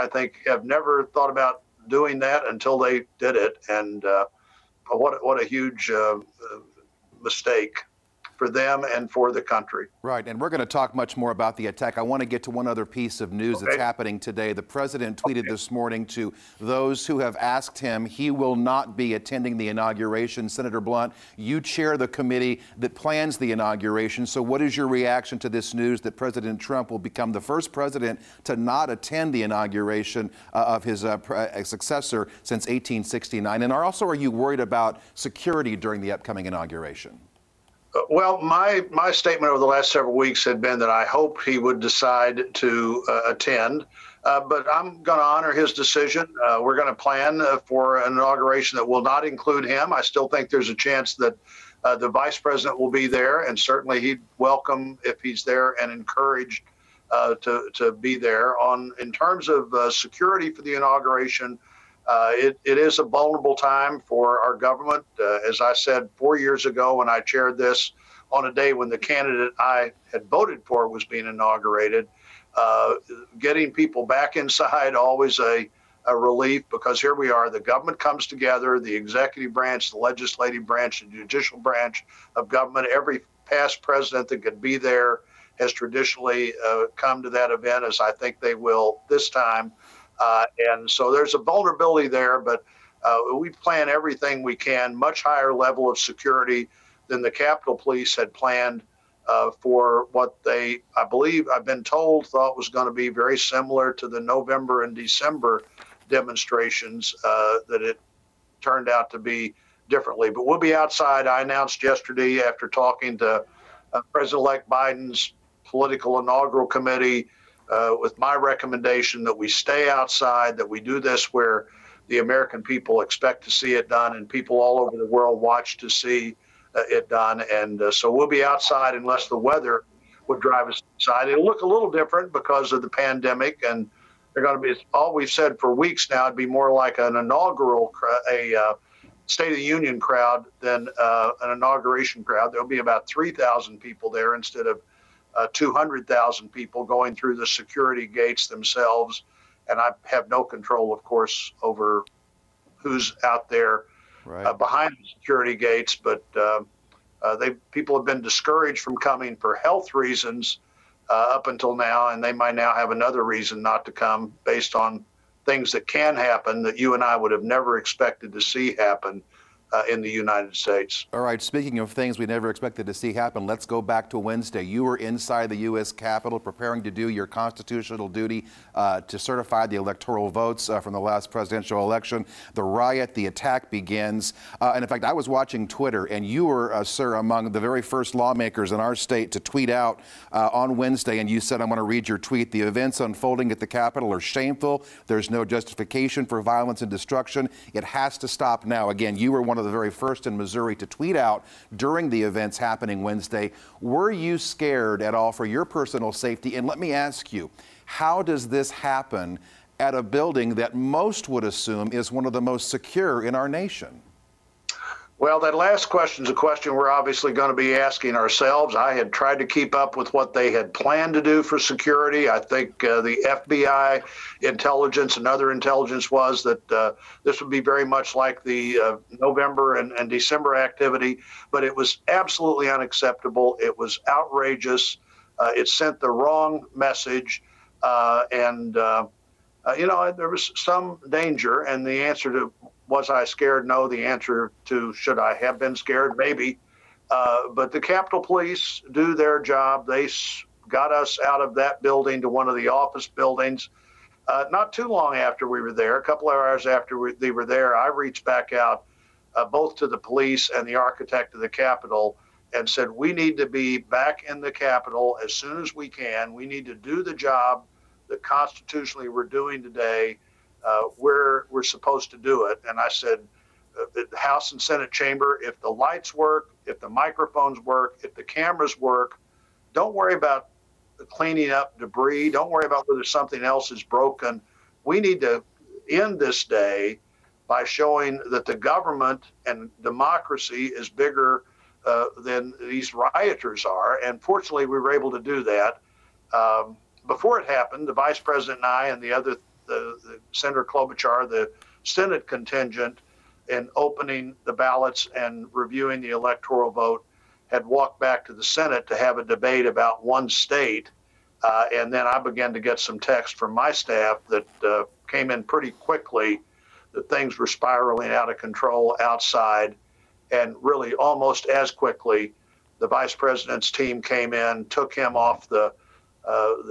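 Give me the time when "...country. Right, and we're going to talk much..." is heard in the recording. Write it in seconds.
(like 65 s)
9 s.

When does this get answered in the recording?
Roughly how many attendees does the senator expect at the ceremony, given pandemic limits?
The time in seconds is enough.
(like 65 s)
143 s.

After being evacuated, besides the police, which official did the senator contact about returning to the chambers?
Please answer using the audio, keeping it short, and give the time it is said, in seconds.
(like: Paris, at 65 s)
Architect of the Capitol, at 260 s.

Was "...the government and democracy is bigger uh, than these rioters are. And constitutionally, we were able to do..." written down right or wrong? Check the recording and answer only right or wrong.
wrong.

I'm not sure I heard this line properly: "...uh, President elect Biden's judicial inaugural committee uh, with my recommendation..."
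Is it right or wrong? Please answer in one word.
wrong.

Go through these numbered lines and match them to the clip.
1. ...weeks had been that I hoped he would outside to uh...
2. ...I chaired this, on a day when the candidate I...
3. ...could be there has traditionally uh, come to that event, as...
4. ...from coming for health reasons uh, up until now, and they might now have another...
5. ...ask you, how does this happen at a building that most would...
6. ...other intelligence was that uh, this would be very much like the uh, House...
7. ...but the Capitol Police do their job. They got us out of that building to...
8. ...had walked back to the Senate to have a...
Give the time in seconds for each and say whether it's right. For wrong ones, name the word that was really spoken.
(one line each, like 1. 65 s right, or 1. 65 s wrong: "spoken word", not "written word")
1. 40 s wrong: "decide", not "outside"
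2. 67 s right
3. 84 s right
4. 158 s right
5. 206 s right
6. 225 s wrong: "November", not "House"
7. 247 s right
8. 307 s right.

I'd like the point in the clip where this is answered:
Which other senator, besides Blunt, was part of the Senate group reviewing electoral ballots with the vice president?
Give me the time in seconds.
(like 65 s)
300 s.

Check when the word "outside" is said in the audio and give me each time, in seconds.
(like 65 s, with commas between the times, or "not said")
110 s, 119 s, 128 s, 319 s.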